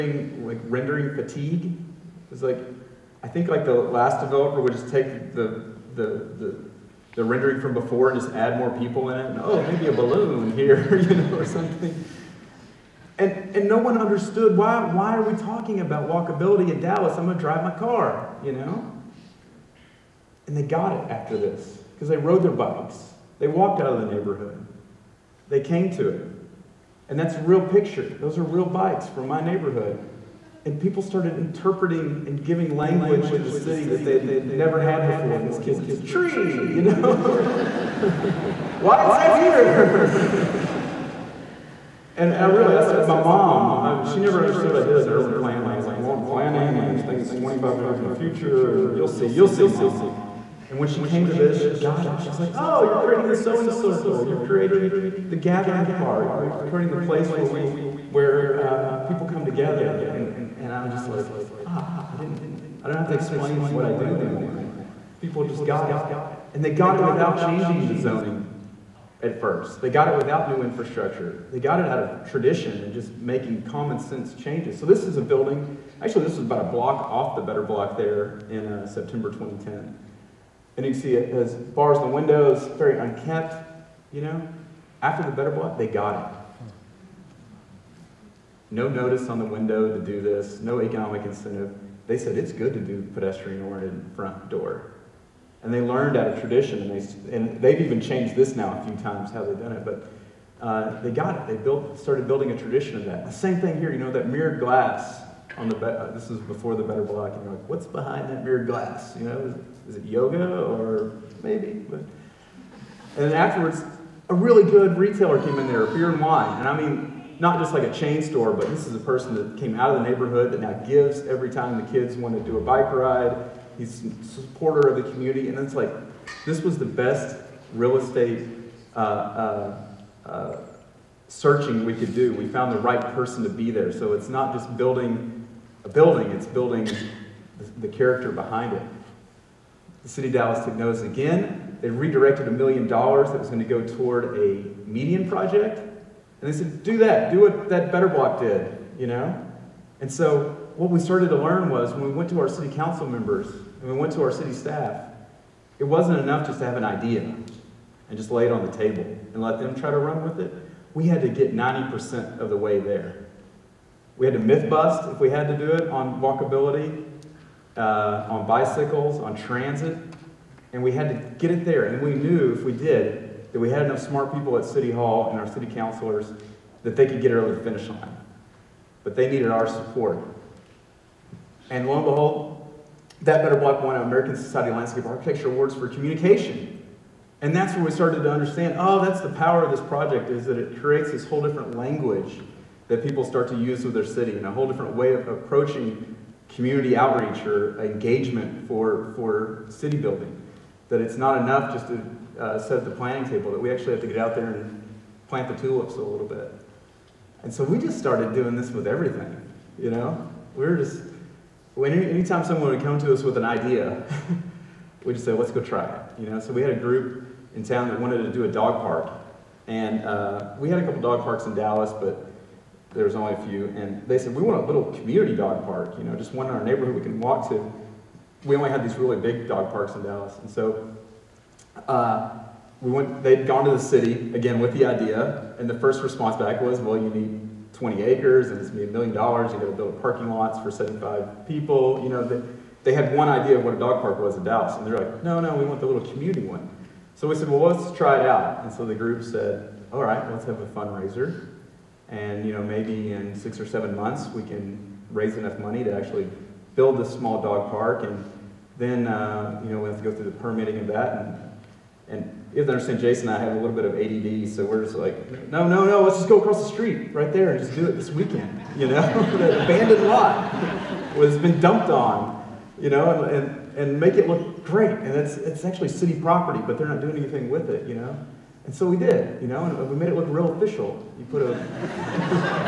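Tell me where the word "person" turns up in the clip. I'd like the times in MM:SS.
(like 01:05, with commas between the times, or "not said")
01:58, 02:12.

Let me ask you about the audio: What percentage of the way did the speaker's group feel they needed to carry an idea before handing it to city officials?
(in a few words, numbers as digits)
90%.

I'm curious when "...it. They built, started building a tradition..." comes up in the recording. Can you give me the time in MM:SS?
01:41.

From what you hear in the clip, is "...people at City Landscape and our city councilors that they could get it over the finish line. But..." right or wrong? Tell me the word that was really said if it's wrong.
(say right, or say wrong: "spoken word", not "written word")
wrong: "Hall", not "Landscape".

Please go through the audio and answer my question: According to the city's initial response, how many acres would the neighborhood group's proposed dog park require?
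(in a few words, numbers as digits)
20 acres.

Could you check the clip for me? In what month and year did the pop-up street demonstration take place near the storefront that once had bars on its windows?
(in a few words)
September 2010.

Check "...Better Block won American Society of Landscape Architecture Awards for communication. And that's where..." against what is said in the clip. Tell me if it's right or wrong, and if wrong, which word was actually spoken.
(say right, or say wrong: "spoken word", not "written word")
right.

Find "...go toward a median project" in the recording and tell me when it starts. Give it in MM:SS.
02:23.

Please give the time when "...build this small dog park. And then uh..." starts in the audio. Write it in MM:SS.
04:16.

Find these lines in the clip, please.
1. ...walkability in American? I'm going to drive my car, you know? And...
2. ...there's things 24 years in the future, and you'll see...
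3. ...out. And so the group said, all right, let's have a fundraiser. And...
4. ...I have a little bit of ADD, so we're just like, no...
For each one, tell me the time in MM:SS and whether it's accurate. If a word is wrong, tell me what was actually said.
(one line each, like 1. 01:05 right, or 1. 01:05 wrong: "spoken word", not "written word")
1. 00:16 wrong: "Dallas", not "American"
2. 00:46 wrong: "25", not "24"
3. 04:08 right
4. 04:23 right.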